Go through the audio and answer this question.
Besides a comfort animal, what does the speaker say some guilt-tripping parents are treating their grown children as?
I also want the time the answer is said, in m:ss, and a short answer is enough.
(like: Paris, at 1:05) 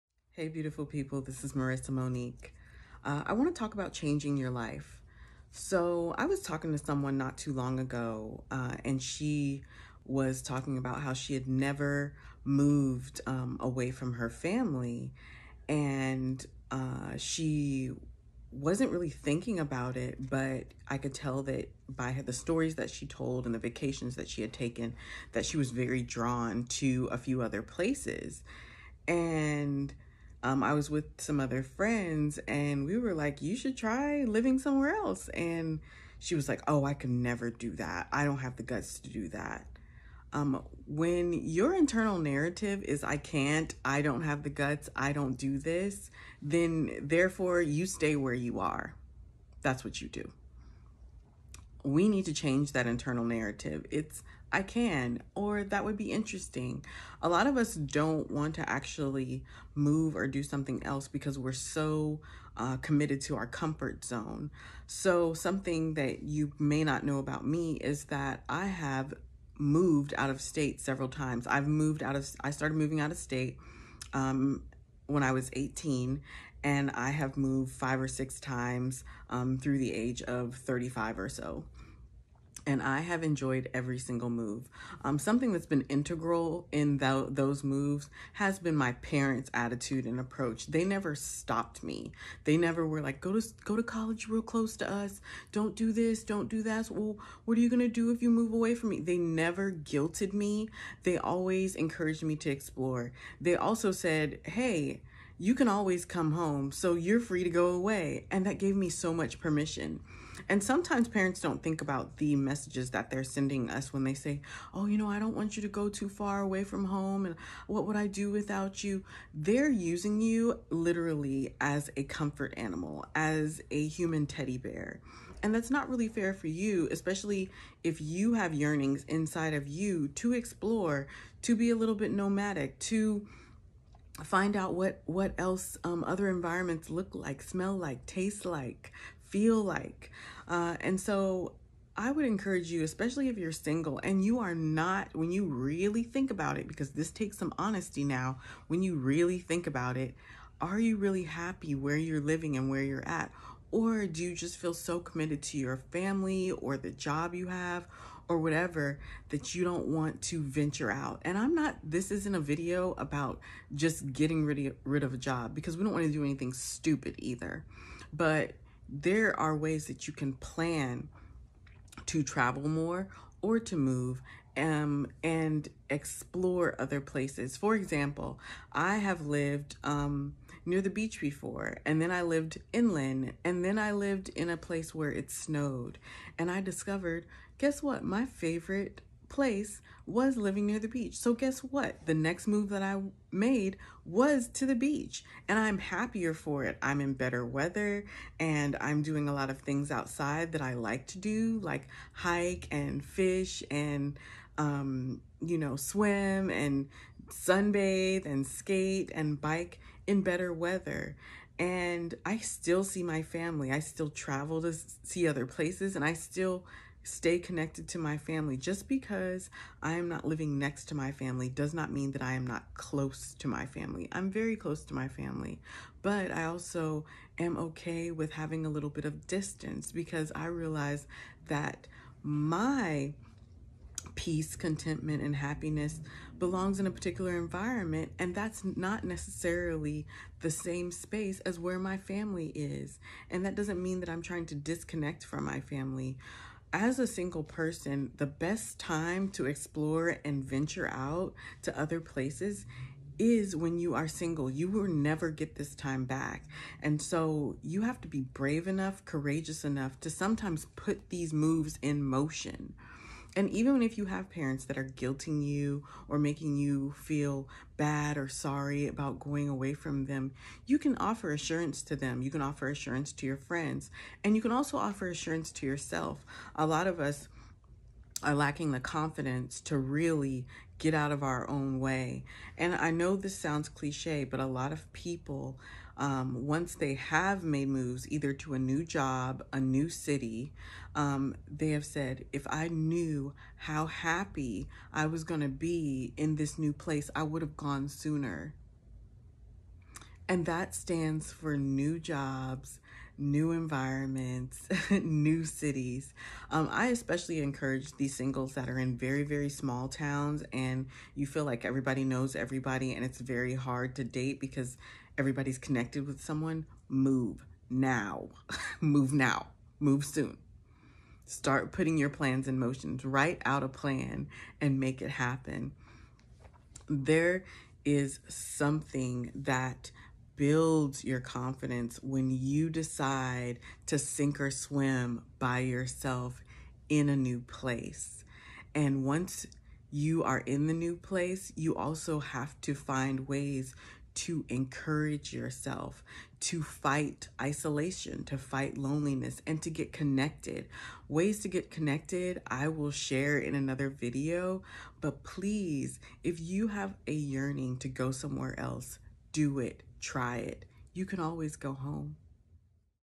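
A human teddy bear, at 2:03.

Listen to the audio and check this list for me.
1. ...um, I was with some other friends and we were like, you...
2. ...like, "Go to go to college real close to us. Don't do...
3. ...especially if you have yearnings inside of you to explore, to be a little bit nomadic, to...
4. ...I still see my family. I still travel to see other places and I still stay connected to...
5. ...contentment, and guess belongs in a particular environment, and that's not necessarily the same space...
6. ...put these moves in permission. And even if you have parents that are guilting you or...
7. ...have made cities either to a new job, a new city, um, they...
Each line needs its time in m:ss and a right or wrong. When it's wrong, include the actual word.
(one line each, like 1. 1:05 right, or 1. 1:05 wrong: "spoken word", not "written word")
1. 0:30 right
2. 1:33 right
3. 2:06 right
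4. 3:32 right
5. 3:54 wrong: "happiness", not "guess"
6. 4:20 wrong: "motion", not "permission"
7. 4:46 wrong: "moves", not "cities".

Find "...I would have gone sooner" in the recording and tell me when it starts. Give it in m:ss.
4:57.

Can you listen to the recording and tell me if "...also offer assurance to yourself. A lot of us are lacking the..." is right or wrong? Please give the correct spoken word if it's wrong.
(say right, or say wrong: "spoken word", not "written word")
right.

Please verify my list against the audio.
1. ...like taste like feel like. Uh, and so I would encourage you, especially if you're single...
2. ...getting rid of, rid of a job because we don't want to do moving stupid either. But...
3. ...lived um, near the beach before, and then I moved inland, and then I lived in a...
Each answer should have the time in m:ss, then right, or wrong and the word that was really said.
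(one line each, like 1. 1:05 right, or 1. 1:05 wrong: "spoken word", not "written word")
1. 2:17 right
2. 2:44 wrong: "anything", not "moving"
3. 2:59 wrong: "lived", not "moved".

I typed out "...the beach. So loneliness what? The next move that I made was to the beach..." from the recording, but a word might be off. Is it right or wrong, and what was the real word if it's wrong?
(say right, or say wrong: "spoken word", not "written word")
wrong: "guess", not "loneliness".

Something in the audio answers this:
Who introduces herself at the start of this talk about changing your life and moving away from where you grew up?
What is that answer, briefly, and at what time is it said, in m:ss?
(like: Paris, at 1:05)
Marissa Monique, at 0:01.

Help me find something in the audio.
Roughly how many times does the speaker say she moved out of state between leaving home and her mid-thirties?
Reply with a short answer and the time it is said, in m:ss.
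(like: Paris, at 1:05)
5 or 6, at 1:17.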